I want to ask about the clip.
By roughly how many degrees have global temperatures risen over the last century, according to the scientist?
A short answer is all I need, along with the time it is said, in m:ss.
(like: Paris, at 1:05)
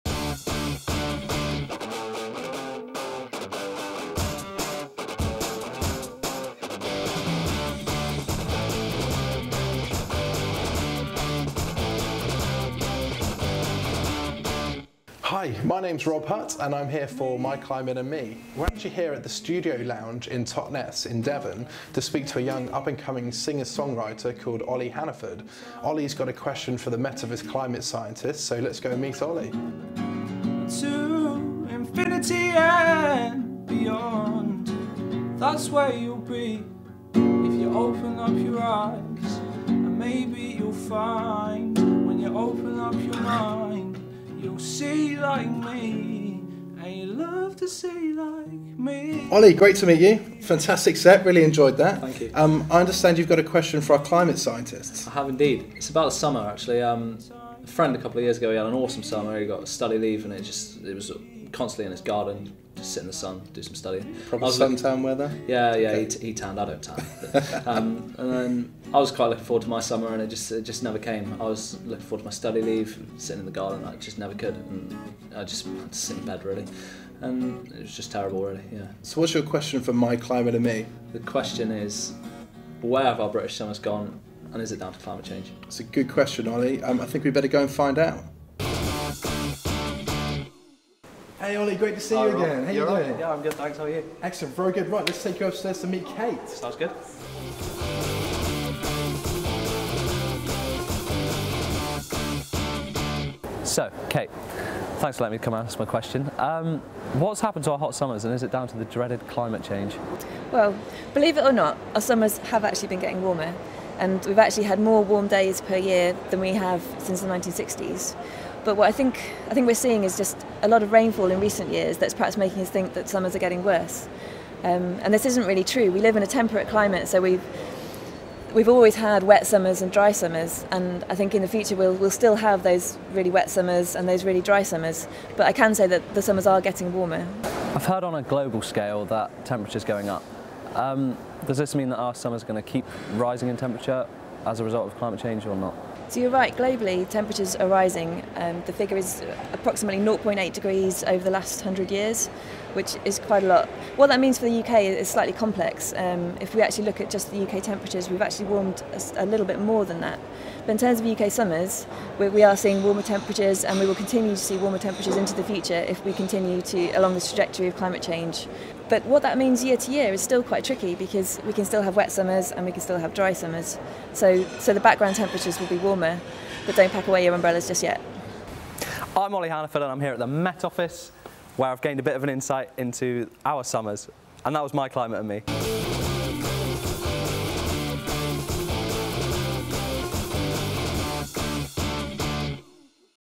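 0.8 degrees, at 2:30.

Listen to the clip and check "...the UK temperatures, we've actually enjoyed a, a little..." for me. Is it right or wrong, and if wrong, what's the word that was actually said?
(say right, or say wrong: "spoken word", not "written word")
wrong: "warmed", not "enjoyed".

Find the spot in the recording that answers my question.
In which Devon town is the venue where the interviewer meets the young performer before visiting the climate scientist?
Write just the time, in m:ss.
0:20.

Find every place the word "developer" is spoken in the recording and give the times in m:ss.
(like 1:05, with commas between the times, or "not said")
not said.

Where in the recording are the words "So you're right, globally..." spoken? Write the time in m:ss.
2:26.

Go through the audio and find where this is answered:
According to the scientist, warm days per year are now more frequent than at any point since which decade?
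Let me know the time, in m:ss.
1:57.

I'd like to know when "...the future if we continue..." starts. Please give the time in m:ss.
2:45.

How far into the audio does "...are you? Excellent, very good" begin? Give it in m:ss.
1:33.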